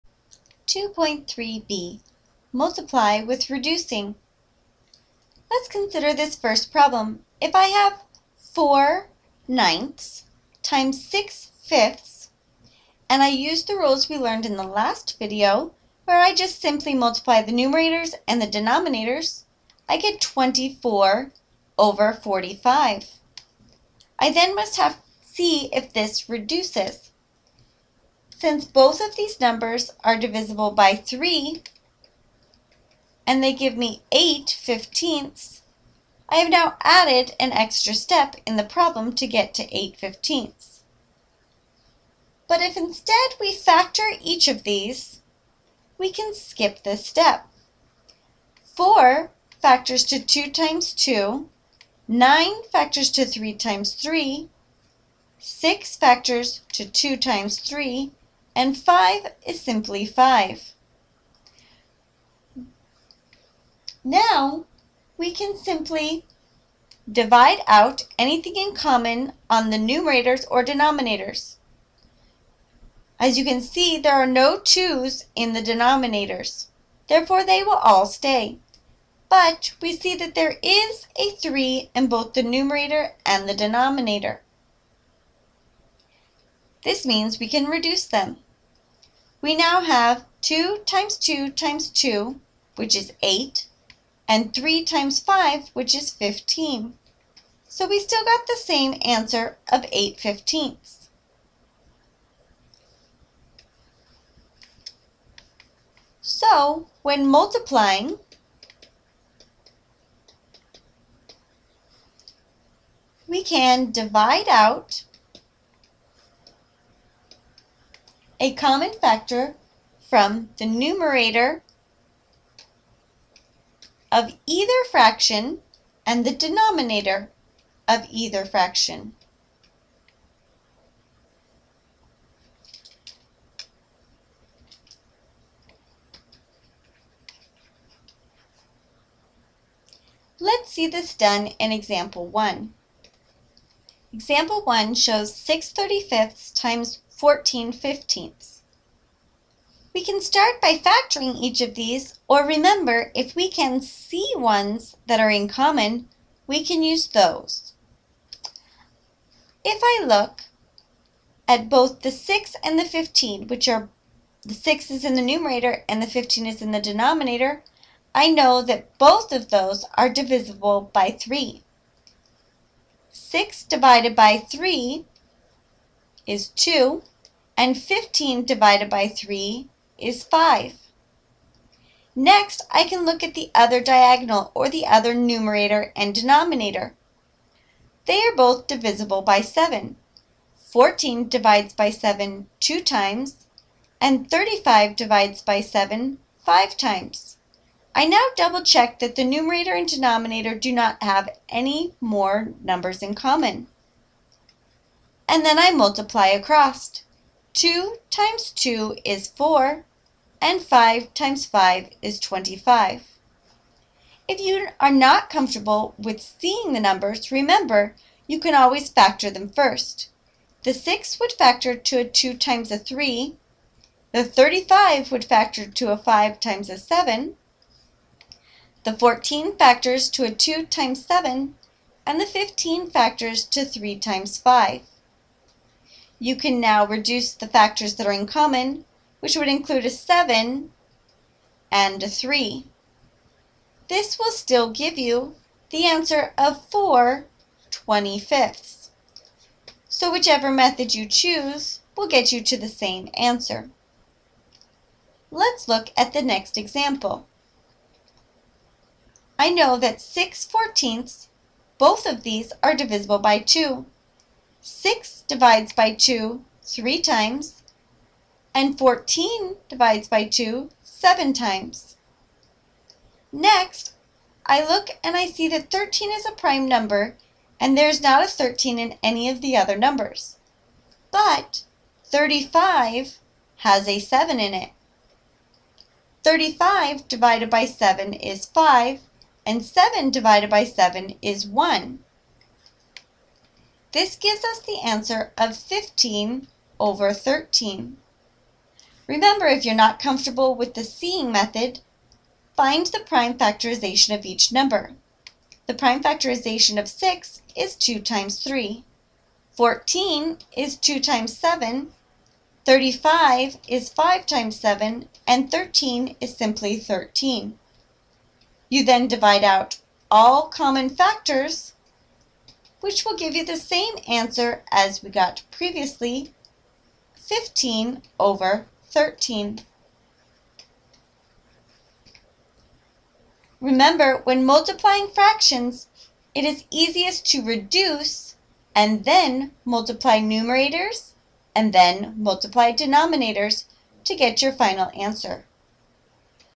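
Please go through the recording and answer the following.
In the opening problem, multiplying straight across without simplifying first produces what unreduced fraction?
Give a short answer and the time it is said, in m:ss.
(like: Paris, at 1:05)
24/45, at 0:20.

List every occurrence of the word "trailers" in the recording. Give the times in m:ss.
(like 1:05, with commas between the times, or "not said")
not said.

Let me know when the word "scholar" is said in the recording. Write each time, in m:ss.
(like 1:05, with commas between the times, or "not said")
not said.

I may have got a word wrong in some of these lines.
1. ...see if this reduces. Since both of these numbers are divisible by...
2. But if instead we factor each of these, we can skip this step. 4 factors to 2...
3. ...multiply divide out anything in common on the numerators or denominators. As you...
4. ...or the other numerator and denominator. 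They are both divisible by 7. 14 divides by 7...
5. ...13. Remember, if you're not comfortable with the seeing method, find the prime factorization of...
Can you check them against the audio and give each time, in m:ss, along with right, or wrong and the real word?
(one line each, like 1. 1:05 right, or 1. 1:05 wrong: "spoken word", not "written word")
1. 0:25 right
2. 0:42 right
3. 1:05 wrong: "simply", not "multiply"
4. 3:04 right
5. 4:57 right.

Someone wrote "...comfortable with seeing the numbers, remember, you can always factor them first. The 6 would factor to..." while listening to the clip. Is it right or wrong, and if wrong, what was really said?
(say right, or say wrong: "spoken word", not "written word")
right.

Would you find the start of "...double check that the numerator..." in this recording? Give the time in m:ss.
3:18.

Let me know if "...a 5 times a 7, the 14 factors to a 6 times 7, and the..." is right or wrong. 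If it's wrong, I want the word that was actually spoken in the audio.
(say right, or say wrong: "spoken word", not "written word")
wrong: "2", not "6".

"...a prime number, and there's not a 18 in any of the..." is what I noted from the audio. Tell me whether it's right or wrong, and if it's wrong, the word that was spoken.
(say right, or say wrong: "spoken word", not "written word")
wrong: "13", not "18".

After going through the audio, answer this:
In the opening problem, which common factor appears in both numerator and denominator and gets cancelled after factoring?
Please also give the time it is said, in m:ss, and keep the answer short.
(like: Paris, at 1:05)
3, at 1:20.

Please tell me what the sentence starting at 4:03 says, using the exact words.
This will still give you the answer of 4 25ths.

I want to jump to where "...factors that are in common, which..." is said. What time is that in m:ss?
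3:57.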